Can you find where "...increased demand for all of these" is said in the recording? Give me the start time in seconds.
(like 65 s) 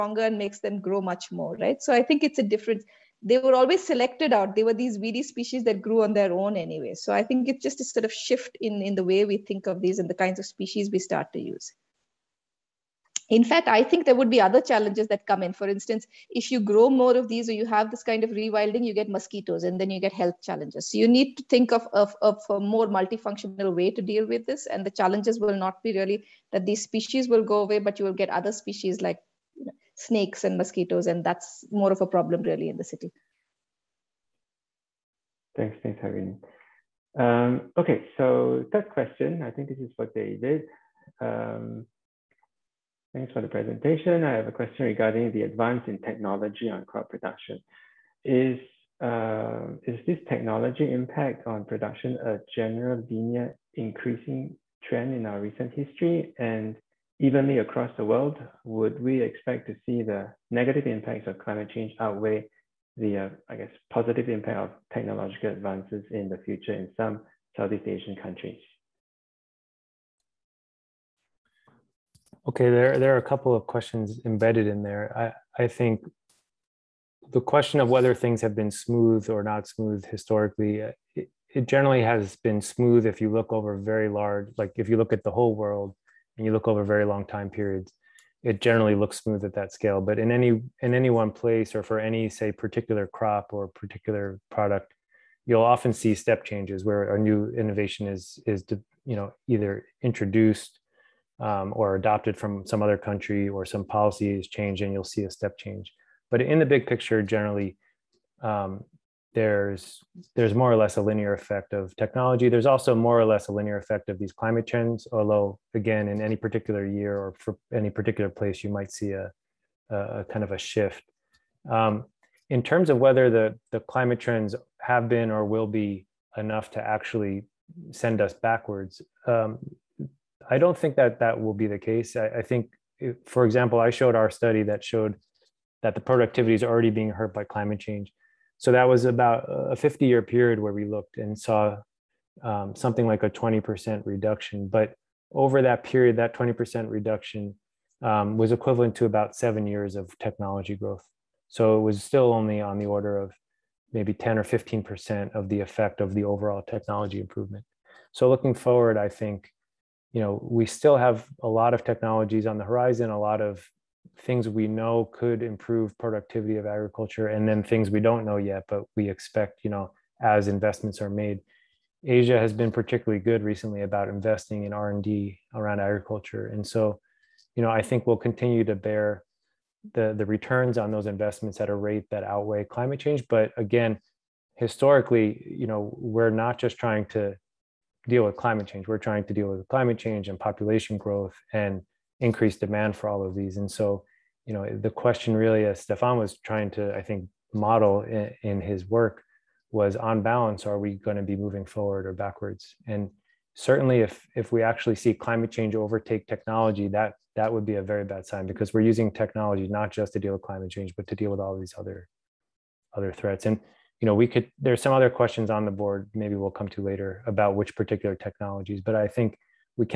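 192 s.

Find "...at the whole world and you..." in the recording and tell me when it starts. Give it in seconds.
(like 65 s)
85 s.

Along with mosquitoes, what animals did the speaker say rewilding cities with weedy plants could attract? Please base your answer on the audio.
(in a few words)
Snakes.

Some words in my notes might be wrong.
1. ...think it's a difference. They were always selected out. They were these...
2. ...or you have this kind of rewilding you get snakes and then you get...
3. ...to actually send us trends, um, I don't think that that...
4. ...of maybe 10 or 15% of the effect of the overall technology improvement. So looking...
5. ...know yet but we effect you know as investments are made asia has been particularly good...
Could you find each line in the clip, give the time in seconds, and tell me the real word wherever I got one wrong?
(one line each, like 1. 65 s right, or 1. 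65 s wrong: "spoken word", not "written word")
1. 2 s right
2. 17 s wrong: "mosquitoes", not "snakes"
3. 126 s wrong: "backwards", not "trends"
4. 153 s right
5. 168 s wrong: "expect", not "effect".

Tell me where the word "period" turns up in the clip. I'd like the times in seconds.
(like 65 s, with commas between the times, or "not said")
87 s, 140 s, 145 s.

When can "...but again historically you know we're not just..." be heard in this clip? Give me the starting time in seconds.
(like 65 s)
183 s.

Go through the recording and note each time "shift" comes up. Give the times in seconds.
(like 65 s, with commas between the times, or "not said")
8 s, 120 s.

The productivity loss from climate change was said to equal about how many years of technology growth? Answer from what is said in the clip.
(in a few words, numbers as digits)
7 years.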